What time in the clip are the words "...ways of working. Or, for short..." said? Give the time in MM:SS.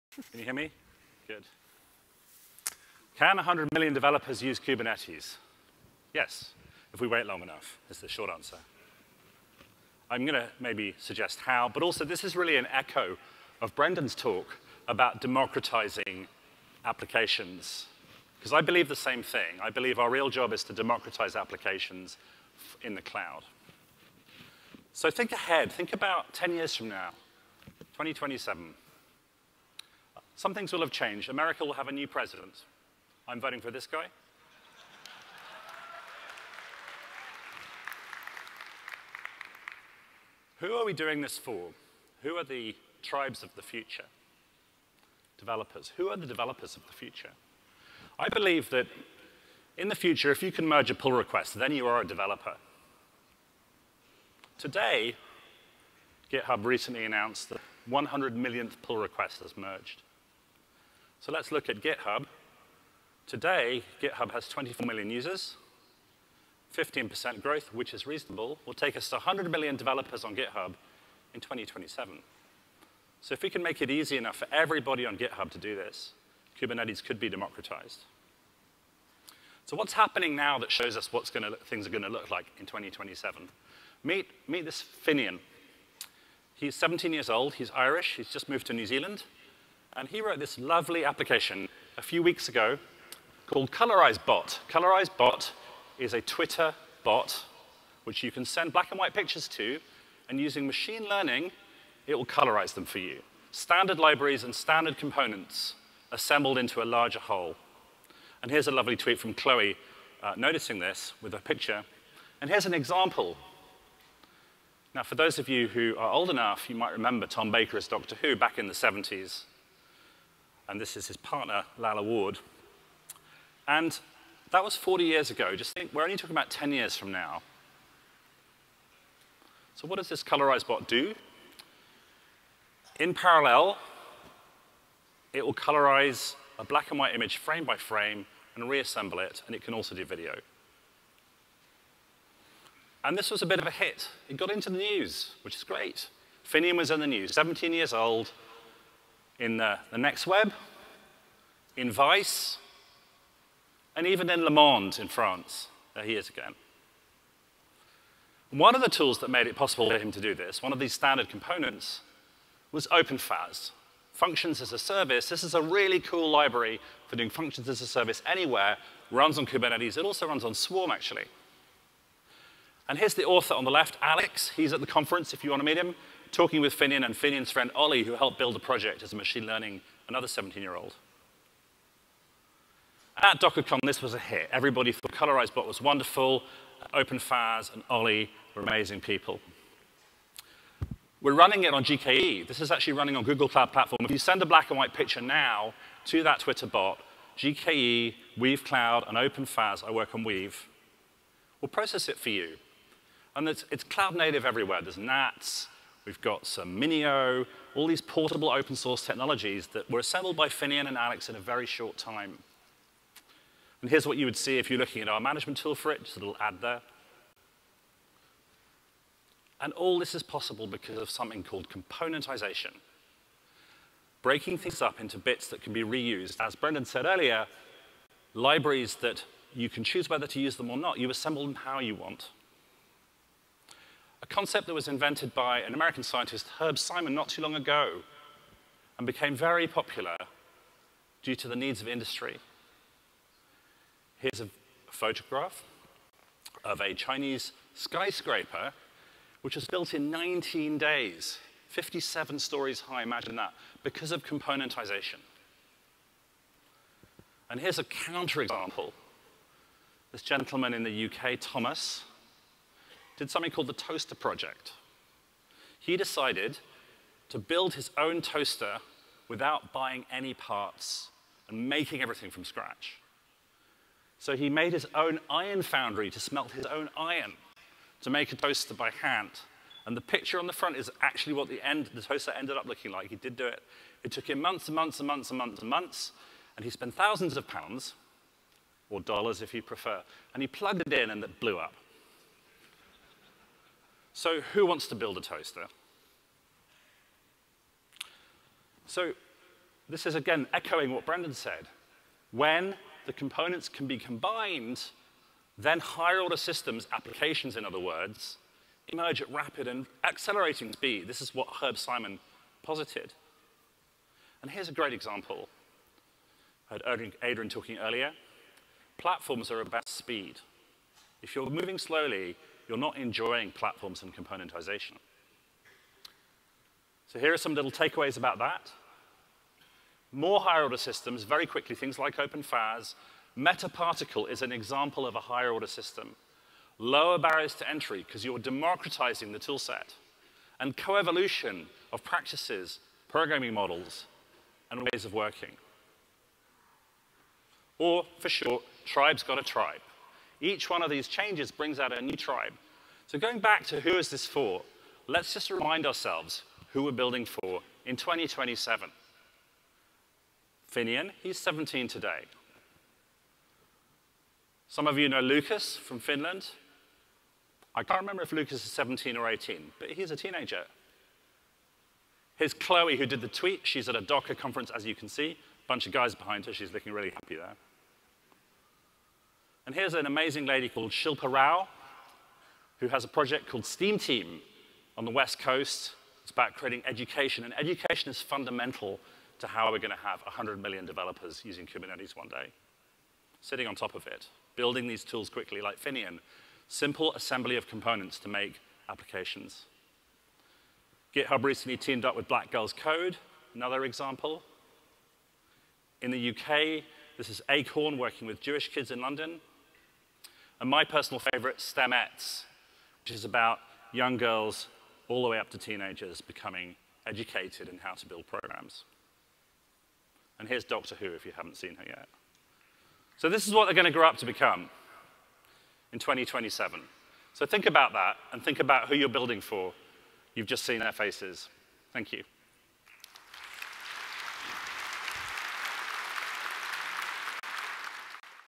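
05:44.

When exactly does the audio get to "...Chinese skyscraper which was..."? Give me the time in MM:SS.
04:06.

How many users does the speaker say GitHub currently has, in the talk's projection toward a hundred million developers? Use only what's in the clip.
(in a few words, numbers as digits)
24 million.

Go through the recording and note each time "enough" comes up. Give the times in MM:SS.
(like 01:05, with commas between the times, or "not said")
00:07, 01:14, 01:56.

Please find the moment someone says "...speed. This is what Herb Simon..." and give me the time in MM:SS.
05:10.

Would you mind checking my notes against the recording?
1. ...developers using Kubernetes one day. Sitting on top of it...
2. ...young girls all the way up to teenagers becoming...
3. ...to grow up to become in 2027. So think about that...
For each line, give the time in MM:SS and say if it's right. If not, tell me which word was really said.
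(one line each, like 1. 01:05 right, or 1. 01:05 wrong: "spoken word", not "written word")
1. 06:30 right
2. 06:53 right
3. 07:03 right.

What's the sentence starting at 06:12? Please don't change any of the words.
Here's Chloe who did the tweet.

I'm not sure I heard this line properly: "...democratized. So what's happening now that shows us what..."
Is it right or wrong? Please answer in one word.
right.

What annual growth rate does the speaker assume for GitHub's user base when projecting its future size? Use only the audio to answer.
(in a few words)
15%.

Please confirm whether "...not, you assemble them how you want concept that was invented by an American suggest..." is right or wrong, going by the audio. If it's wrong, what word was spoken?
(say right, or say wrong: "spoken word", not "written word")
wrong: "scientist", not "suggest".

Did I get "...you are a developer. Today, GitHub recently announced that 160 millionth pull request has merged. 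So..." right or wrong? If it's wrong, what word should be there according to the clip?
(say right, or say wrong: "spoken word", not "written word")
wrong: "100", not "160".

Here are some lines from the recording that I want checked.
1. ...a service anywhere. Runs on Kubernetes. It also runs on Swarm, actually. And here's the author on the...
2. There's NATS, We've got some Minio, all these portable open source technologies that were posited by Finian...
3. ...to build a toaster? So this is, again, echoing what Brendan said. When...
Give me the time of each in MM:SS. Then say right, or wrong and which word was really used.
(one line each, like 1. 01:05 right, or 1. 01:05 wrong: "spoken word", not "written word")
1. 02:47 right
2. 03:24 wrong: "assembled", not "posited"
3. 04:54 right.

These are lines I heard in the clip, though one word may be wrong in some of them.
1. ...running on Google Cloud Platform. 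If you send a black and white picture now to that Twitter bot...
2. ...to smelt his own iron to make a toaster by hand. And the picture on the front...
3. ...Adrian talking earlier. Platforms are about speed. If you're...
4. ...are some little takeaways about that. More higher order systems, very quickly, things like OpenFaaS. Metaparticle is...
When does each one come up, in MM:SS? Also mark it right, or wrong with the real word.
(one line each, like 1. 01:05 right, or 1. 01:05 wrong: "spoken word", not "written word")
1. 03:12 right
2. 04:36 right
3. 05:17 right
4. 05:27 right.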